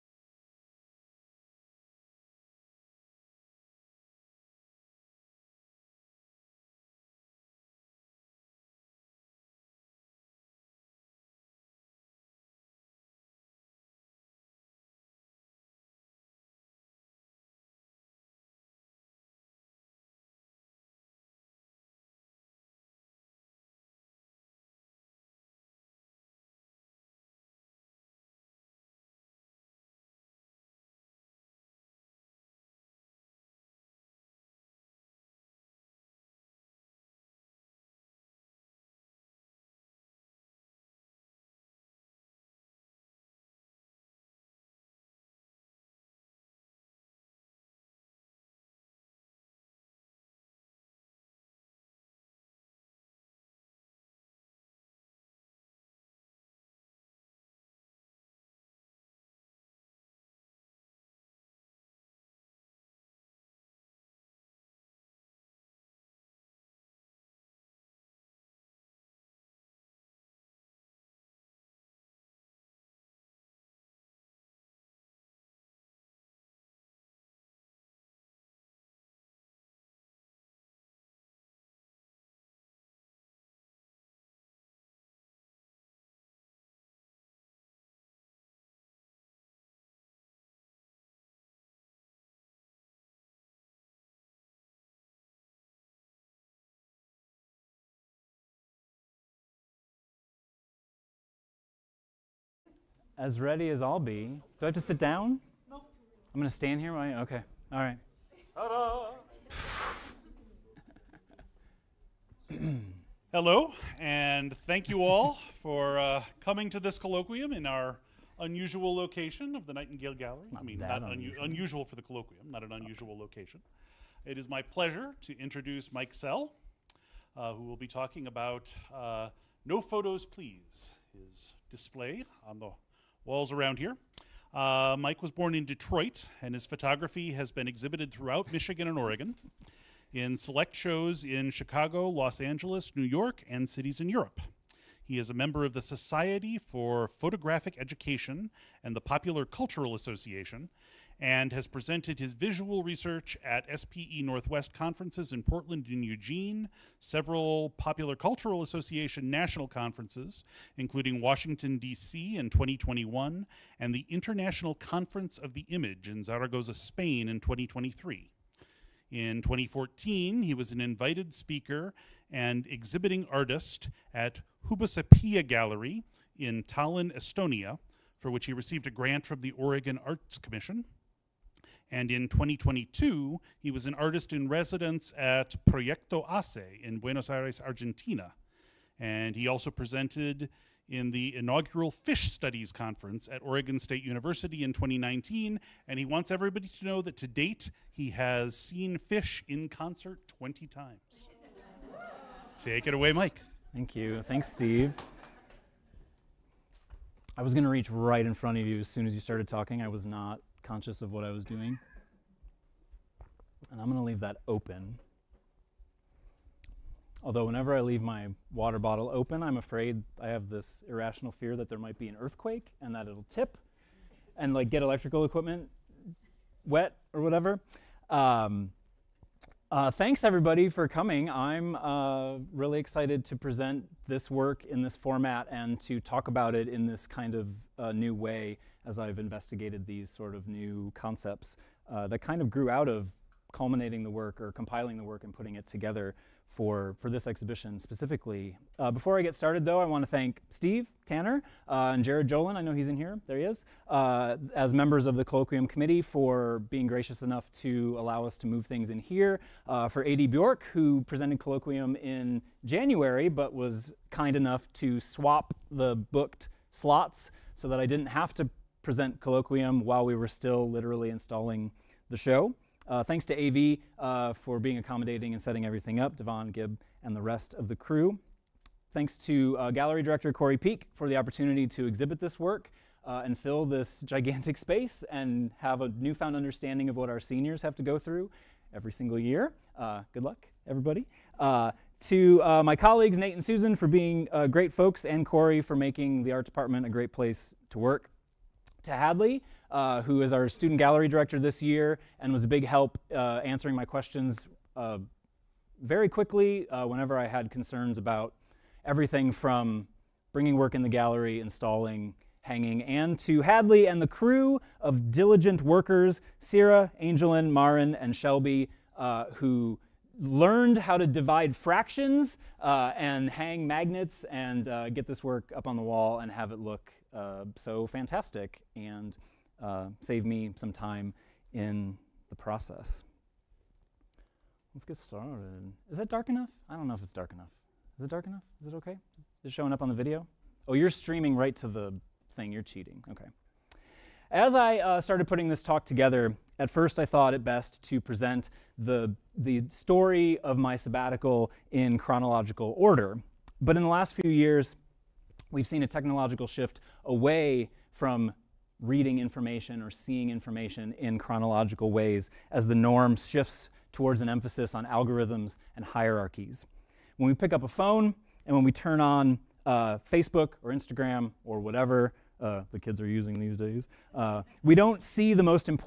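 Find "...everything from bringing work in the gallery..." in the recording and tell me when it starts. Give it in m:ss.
5:08.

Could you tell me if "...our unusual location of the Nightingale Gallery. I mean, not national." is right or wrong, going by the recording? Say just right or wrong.
wrong.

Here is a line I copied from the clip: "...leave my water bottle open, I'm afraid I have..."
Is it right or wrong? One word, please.
right.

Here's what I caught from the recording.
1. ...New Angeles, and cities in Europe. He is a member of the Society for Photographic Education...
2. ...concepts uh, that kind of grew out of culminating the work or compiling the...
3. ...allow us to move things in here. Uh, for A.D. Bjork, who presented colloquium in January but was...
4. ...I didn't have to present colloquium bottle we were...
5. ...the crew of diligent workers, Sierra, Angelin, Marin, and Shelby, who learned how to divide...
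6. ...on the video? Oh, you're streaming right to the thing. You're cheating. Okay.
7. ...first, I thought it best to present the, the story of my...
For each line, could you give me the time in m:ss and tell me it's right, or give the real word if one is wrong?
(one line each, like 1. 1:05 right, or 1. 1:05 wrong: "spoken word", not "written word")
1. 2:22 wrong: "York", not "Angeles"
2. 4:00 right
3. 4:17 right
4. 4:27 wrong: "while", not "bottle"
5. 5:14 right
6. 5:39 right
7. 5:46 right.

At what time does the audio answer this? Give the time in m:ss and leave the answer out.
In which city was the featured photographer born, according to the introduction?
2:15.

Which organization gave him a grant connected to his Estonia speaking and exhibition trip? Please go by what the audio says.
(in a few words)
Oregon Arts Commission.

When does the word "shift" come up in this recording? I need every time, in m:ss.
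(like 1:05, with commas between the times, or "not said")
5:56, 6:03.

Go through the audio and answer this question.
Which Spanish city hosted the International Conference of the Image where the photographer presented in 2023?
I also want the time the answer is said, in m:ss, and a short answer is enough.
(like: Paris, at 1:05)
Zaragoza, at 2:46.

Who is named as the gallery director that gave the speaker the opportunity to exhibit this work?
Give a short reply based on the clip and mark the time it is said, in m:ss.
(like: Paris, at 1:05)
Corey Peak, at 4:40.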